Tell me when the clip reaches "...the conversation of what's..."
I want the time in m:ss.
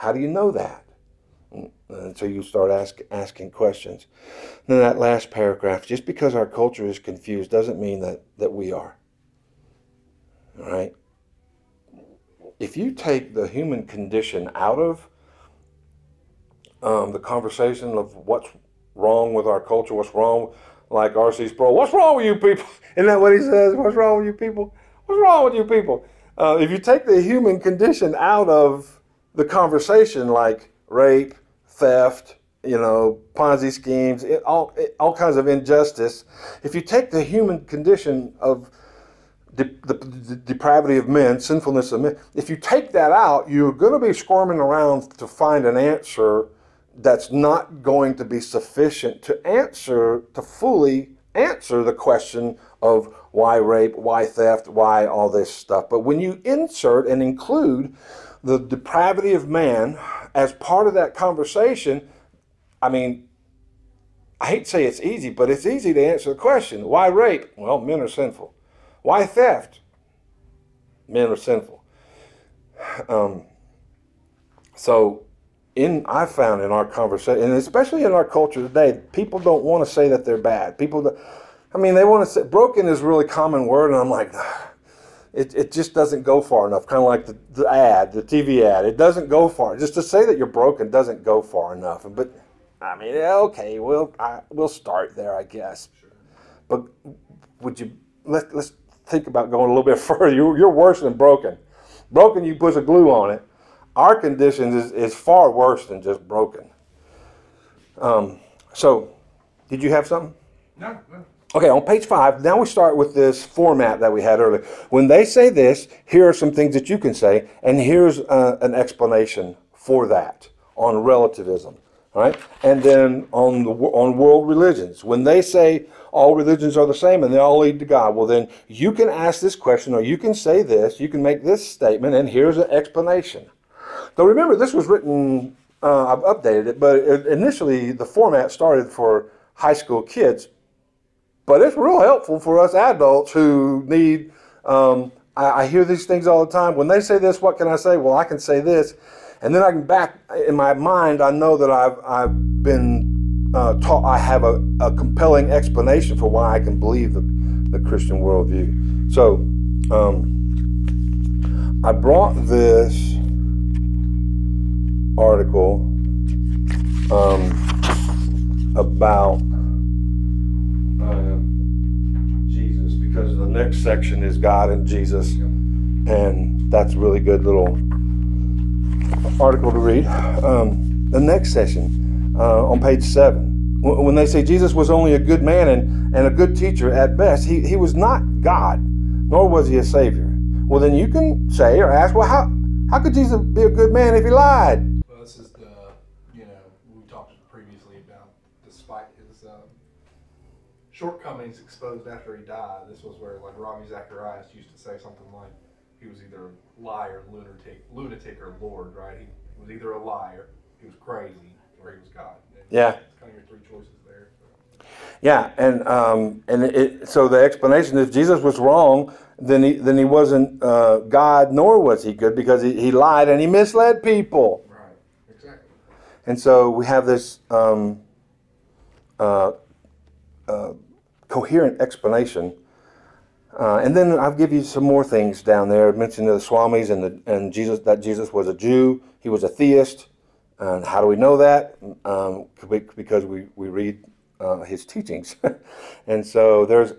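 0:17.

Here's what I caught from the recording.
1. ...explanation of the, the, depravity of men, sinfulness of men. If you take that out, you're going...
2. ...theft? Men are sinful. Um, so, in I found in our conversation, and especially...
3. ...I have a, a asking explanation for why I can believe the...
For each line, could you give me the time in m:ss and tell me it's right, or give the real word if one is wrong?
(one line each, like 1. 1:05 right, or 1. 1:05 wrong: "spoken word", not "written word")
1. 0:37 wrong: "condition", not "explanation"
2. 1:09 right
3. 2:34 wrong: "compelling", not "asking".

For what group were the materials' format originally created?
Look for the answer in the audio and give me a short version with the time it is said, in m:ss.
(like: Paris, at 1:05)
high school kids, at 2:19.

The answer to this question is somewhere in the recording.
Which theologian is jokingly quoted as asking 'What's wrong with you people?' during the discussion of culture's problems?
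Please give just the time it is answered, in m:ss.
0:21.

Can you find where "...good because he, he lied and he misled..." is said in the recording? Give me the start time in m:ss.
3:42.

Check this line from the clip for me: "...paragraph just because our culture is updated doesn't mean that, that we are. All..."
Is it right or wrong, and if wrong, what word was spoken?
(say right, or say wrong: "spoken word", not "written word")
wrong: "confused", not "updated".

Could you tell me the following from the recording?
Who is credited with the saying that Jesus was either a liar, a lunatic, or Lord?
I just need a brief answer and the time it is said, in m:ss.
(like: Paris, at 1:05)
Ravi Zacharias, at 3:23.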